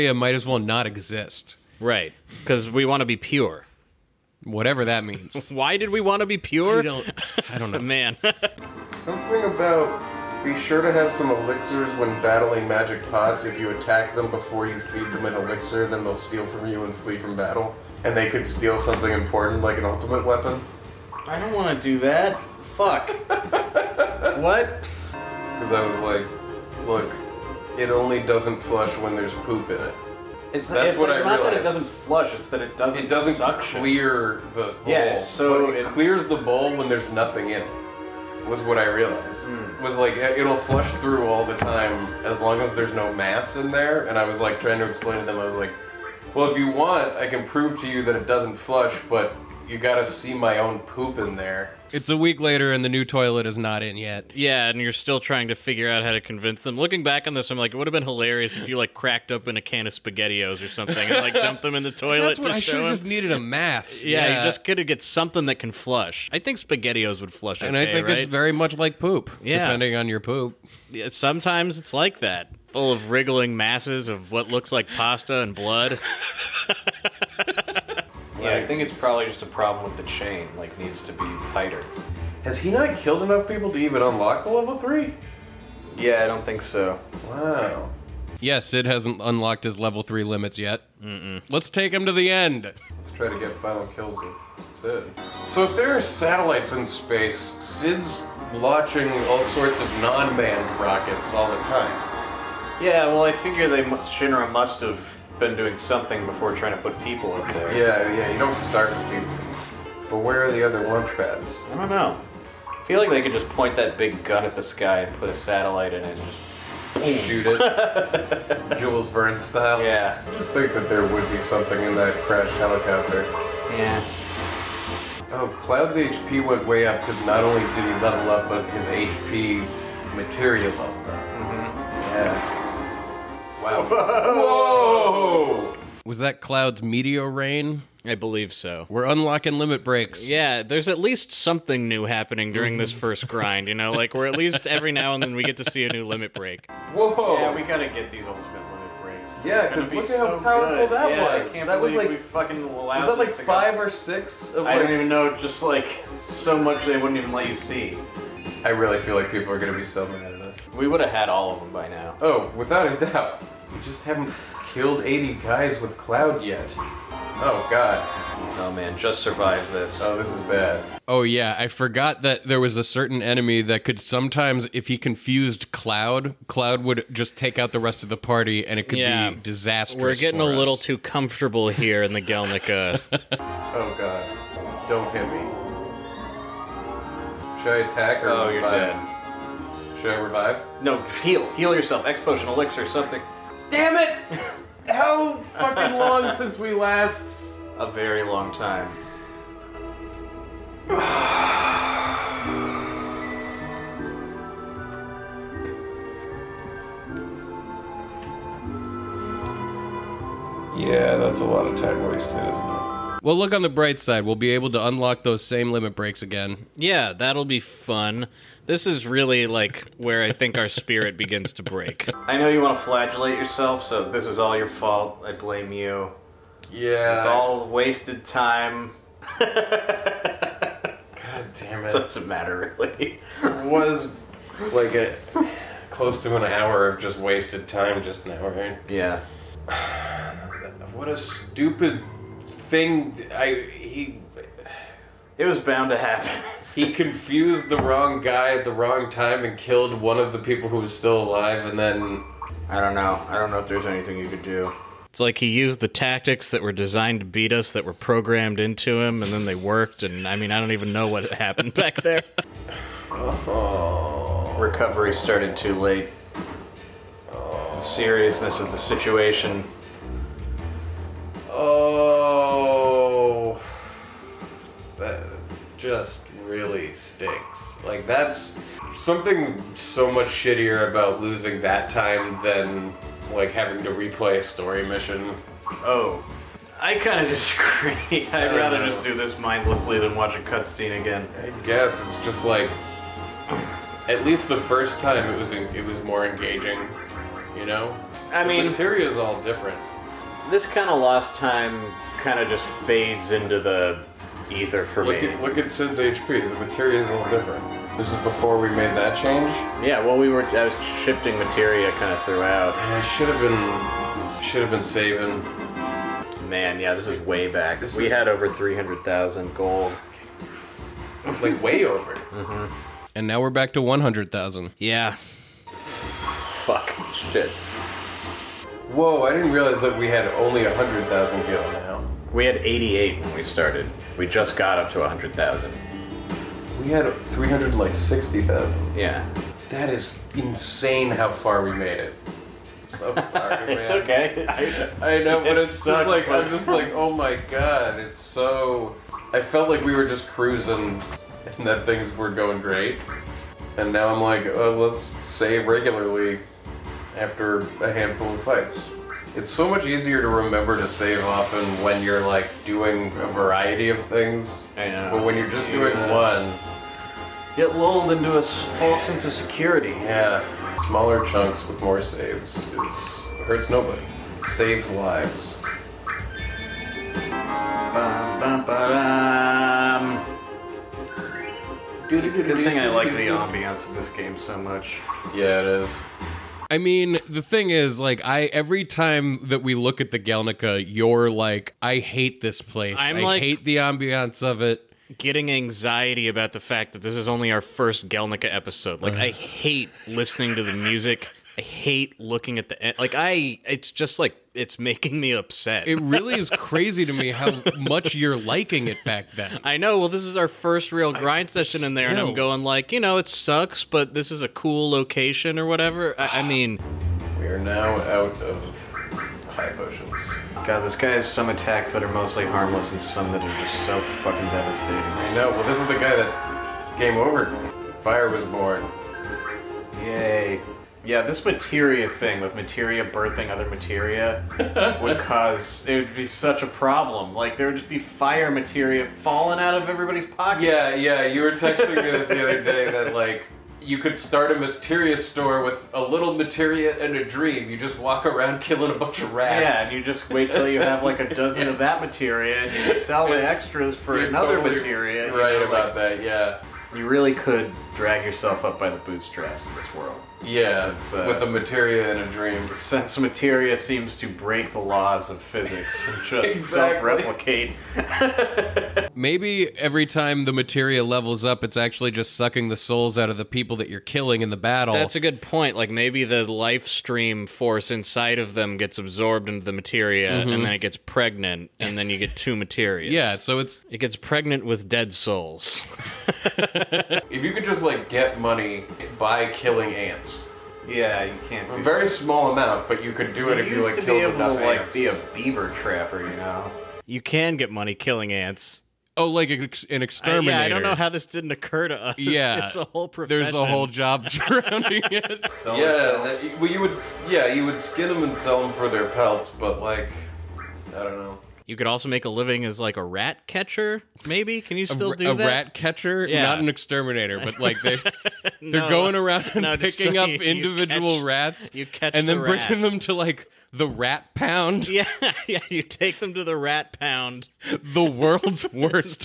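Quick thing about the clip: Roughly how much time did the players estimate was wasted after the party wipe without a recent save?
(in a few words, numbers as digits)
close to an hour.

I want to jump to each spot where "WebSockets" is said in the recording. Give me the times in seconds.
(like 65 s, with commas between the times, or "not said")
not said.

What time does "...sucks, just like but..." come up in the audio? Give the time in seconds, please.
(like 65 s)
345 s.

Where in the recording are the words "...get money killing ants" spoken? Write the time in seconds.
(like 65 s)
497 s.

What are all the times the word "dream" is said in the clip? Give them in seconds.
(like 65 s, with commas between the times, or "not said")
447 s, 462 s.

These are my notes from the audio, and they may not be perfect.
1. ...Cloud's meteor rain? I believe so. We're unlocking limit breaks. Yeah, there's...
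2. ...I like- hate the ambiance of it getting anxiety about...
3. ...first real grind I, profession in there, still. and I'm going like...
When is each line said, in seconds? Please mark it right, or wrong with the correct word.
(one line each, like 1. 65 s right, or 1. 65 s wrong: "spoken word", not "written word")
1. 136 s right
2. 393 s right
3. 410 s wrong: "session", not "profession".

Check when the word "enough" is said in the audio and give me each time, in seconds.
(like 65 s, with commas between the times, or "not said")
83 s, 494 s.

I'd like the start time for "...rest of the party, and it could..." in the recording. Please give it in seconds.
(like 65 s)
177 s.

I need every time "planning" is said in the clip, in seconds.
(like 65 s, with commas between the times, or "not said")
not said.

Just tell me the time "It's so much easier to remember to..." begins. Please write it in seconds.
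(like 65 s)
359 s.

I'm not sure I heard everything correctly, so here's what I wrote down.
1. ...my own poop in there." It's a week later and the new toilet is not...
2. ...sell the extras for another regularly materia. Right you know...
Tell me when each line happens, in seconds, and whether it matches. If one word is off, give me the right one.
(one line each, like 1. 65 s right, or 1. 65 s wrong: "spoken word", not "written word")
1. 50 s right
2. 452 s wrong: "totally", not "regularly".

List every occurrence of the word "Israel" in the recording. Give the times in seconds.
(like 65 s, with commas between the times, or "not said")
not said.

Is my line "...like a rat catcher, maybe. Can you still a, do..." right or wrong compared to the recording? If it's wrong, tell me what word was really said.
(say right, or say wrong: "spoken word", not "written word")
right.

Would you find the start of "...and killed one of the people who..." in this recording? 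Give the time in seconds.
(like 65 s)
249 s.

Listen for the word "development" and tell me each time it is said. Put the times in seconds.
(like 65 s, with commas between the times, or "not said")
not said.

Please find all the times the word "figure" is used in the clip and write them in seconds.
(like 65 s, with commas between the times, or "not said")
55 s, 103 s.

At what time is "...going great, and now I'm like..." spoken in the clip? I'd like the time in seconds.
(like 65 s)
352 s.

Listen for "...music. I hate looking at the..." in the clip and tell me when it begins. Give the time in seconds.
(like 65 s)
400 s.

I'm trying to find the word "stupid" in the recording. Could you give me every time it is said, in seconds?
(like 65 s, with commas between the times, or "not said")
241 s.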